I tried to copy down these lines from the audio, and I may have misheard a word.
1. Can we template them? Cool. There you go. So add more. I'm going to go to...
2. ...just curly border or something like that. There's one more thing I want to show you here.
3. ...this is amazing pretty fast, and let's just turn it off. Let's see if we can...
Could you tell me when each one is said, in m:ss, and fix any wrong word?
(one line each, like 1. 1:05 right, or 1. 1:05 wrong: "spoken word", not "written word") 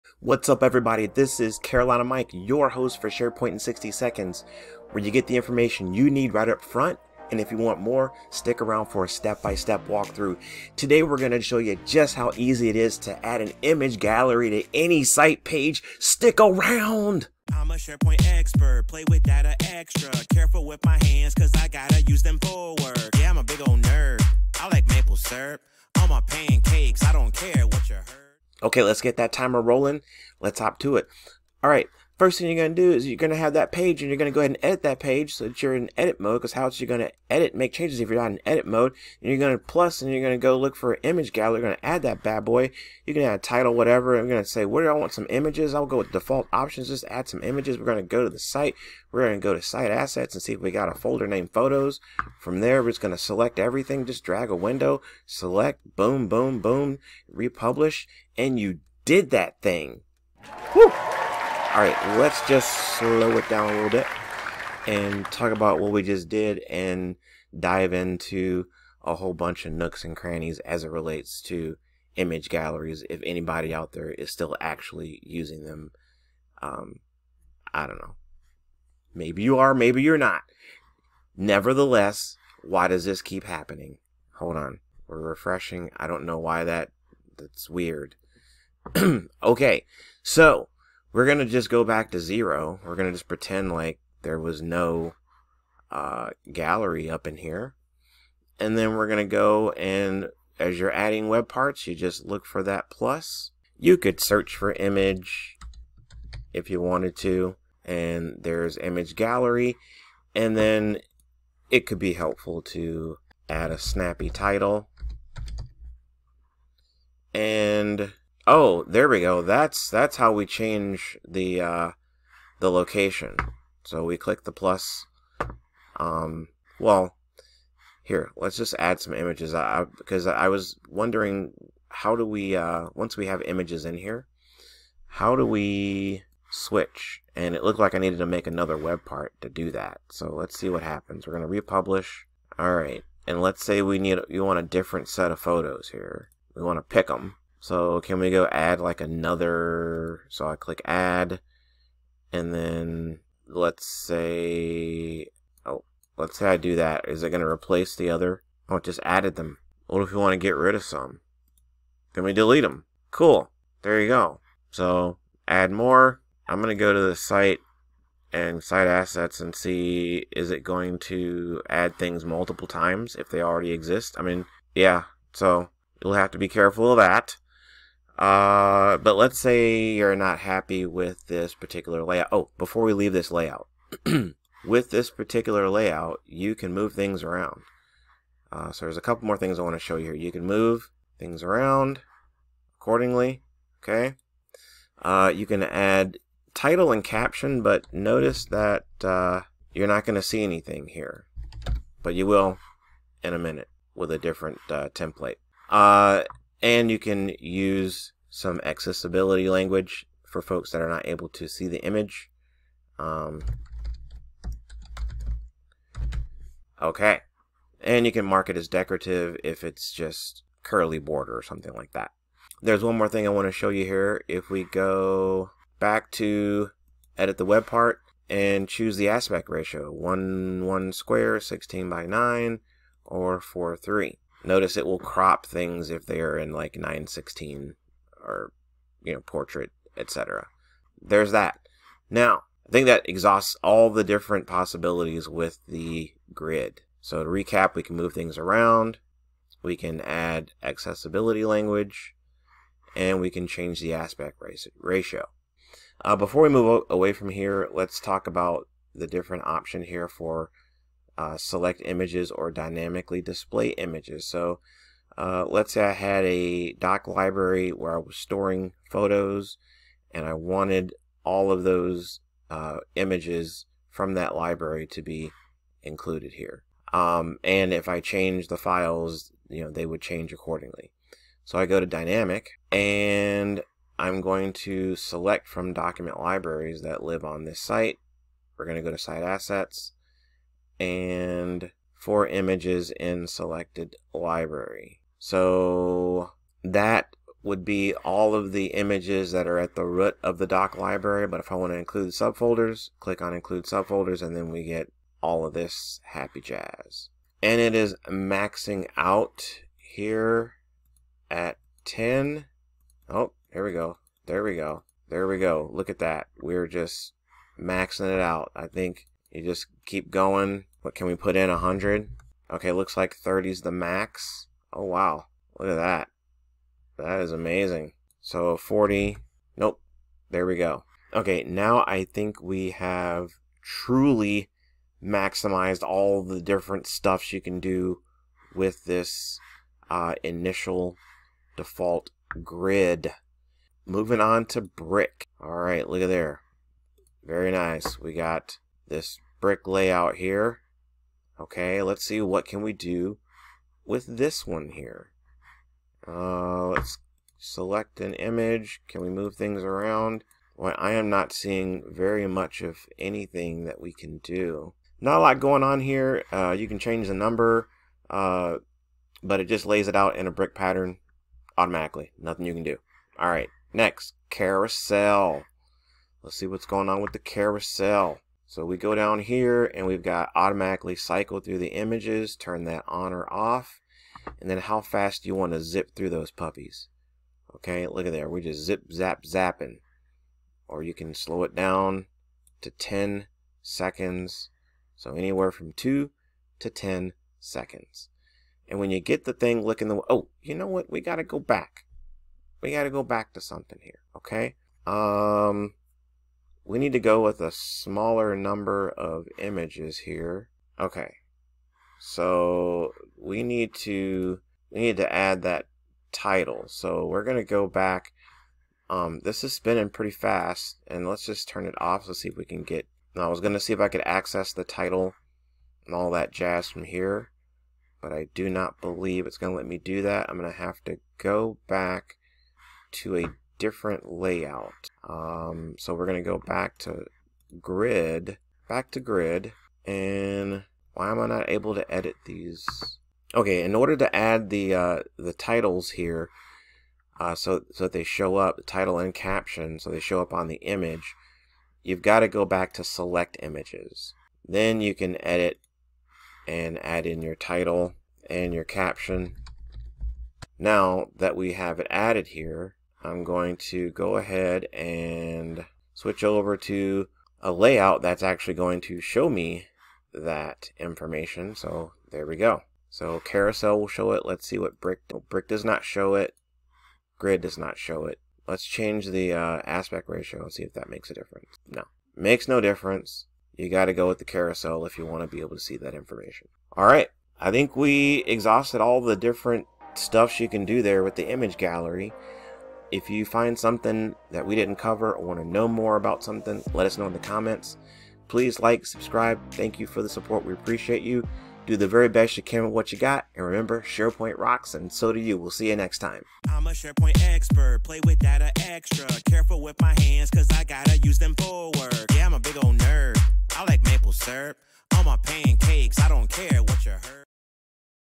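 1. 2:42 wrong: "delete", not "template"
2. 3:39 right
3. 6:59 wrong: "spinning", not "amazing".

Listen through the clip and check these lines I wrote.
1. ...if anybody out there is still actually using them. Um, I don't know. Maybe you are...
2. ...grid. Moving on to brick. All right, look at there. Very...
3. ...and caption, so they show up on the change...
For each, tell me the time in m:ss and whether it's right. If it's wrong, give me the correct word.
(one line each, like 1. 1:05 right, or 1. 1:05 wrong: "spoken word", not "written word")
1. 1:13 right
2. 5:42 right
3. 7:28 wrong: "image", not "change".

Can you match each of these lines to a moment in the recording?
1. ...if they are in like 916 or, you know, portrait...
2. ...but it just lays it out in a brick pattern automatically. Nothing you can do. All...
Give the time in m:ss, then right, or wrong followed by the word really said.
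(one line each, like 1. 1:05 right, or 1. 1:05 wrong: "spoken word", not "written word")
1. 3:55 right
2. 6:09 right.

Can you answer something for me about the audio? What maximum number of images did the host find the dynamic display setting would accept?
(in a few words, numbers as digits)
30.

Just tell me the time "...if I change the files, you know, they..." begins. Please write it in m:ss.
4:37.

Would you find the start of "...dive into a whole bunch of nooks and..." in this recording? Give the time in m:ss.
1:07.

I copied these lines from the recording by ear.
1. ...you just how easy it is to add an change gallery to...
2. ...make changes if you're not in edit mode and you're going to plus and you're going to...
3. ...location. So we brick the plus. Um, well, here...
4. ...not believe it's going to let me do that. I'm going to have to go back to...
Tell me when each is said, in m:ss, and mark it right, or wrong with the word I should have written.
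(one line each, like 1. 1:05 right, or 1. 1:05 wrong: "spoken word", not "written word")
1. 0:11 wrong: "image", not "change"
2. 0:37 right
3. 2:02 wrong: "click", not "brick"
4. 7:08 right.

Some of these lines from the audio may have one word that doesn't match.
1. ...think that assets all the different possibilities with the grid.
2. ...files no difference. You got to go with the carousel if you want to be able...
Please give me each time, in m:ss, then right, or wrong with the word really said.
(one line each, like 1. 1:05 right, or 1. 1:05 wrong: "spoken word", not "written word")
1. 4:02 wrong: "exhausts", not "assets"
2. 8:02 wrong: "makes", not "files".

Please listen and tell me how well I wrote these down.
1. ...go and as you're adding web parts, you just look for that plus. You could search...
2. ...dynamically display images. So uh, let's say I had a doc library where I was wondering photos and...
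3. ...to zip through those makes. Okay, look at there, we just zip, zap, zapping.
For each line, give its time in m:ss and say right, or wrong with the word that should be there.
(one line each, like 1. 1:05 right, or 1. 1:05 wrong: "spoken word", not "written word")
1. 1:39 right
2. 4:22 wrong: "storing", not "wondering"
3. 6:25 wrong: "puppies", not "makes".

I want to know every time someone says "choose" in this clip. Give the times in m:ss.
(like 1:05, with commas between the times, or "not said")
3:48.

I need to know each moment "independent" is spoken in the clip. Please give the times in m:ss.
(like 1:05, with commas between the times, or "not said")
not said.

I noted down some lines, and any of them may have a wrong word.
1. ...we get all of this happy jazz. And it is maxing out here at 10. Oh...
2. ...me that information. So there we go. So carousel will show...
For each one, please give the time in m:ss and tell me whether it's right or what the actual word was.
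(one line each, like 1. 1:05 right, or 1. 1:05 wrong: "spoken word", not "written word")
1. 5:04 right
2. 7:49 right.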